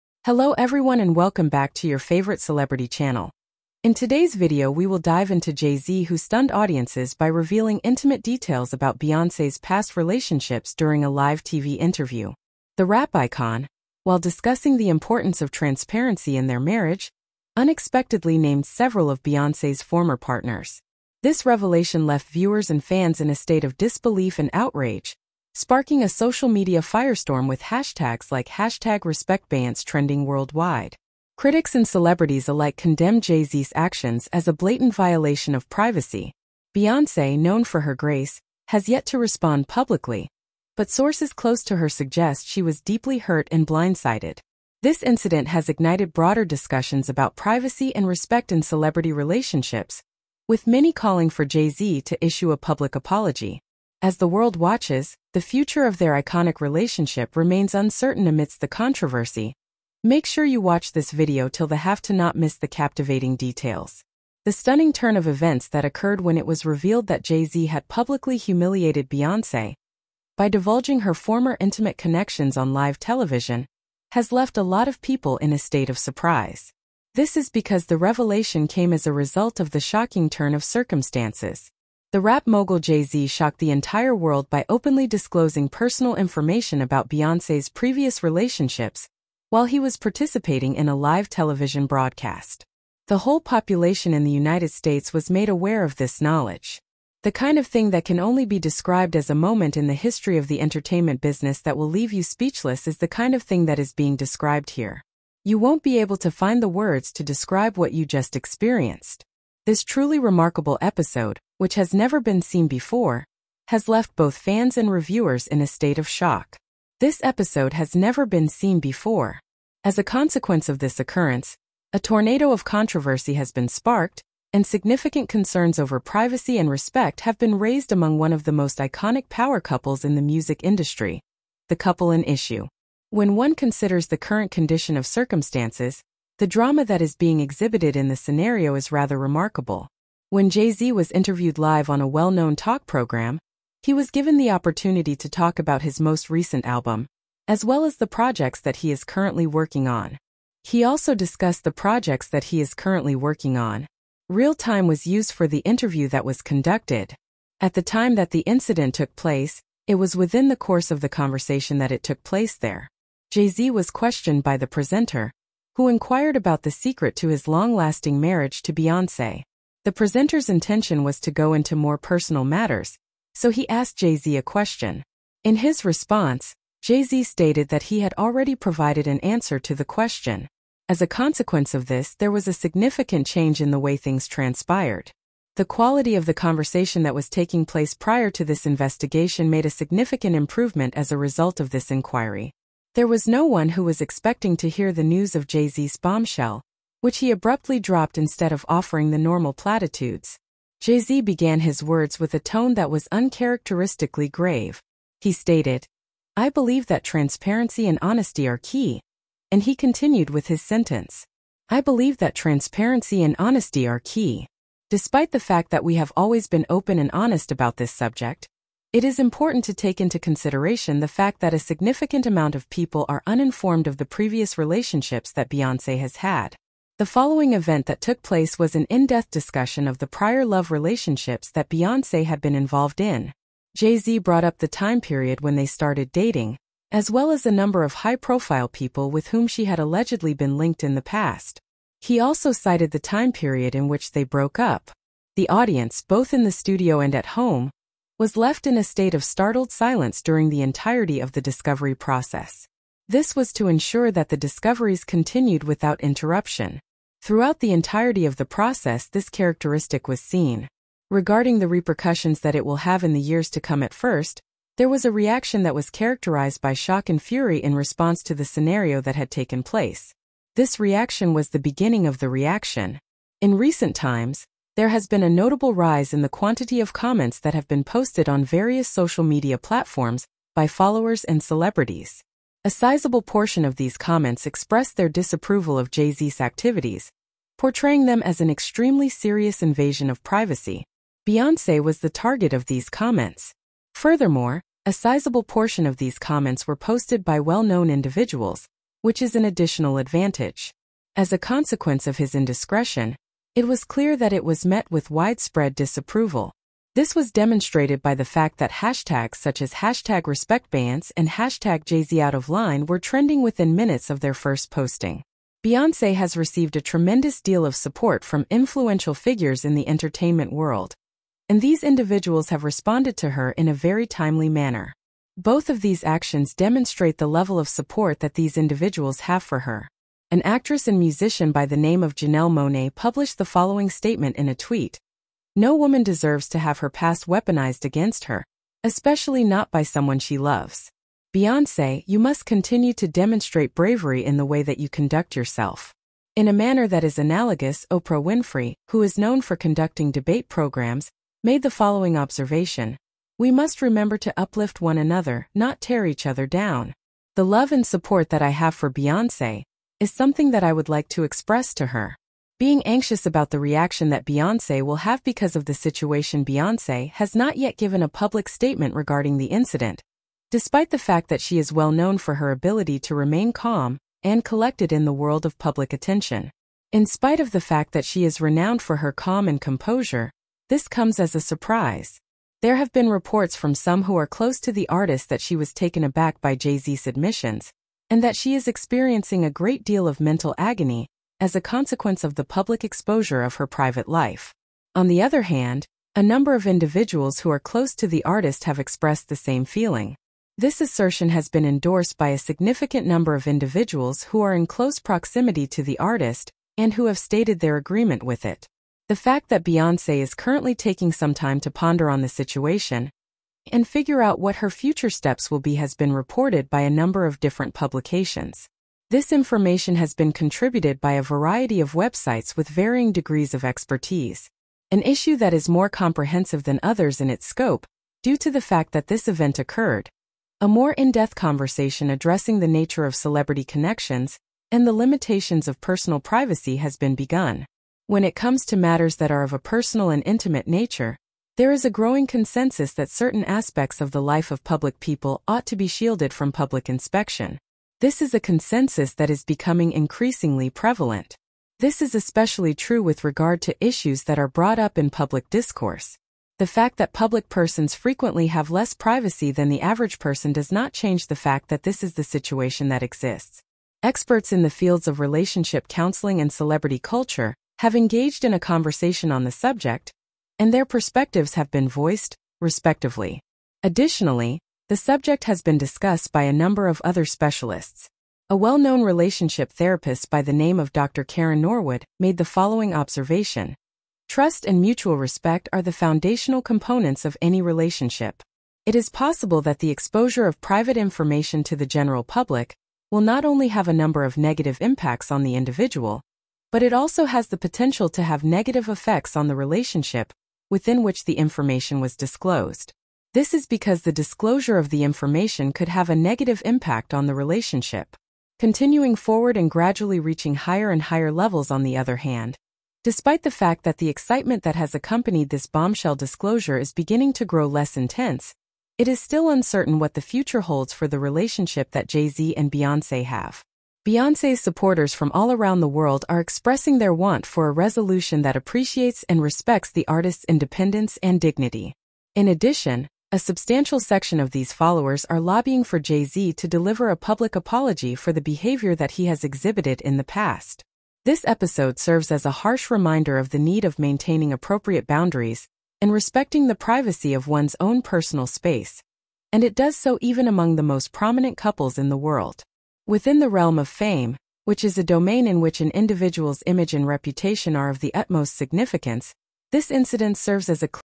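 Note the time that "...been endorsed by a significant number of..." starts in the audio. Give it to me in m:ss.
6:41.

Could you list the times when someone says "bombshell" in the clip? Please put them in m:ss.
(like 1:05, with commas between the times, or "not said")
3:15, 8:35.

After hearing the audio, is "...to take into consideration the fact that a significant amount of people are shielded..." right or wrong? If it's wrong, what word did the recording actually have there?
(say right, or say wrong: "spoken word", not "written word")
wrong: "uninformed", not "shielded".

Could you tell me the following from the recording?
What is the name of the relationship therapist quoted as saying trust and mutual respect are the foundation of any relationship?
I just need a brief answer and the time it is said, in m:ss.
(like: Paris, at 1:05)
Dr. Karen Norwood, at 8:00.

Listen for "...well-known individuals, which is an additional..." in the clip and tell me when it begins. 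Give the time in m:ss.
4:57.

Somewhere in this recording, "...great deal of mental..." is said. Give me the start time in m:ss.
6:29.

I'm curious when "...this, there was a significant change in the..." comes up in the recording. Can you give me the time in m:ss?
3:01.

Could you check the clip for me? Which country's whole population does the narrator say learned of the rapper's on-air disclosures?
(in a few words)
United States.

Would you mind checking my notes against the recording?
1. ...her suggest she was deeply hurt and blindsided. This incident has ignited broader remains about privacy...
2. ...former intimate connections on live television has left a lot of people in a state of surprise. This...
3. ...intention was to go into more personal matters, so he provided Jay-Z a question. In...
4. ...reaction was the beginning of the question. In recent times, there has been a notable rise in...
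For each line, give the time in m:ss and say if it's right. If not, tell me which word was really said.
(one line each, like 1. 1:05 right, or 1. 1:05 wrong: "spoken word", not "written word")
1. 0:41 wrong: "discussions", not "remains"
2. 1:11 right
3. 2:50 wrong: "asked", not "provided"
4. 4:30 wrong: "reaction", not "question".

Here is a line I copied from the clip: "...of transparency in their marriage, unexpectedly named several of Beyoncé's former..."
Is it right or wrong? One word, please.
right.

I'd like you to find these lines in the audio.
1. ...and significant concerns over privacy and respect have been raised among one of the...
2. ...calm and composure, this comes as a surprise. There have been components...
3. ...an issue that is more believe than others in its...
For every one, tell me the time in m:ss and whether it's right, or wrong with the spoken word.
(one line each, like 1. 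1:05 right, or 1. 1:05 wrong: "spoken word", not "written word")
1. 2:04 right
2. 6:19 wrong: "reports", not "components"
3. 7:04 wrong: "comprehensive", not "believe".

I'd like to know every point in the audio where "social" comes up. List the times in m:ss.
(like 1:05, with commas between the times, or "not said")
0:26, 4:38.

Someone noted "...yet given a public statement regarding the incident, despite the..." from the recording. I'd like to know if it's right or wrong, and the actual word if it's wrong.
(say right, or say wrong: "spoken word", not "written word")
right.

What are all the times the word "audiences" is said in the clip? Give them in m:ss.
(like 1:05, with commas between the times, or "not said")
0:06, 4:05.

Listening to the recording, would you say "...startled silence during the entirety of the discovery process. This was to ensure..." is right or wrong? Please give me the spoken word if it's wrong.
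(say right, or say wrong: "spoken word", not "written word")
right.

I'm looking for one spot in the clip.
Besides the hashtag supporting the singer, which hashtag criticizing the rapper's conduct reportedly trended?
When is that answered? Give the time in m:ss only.
5:11.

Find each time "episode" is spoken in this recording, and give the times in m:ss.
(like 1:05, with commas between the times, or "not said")
1:50, 1:57, 9:01.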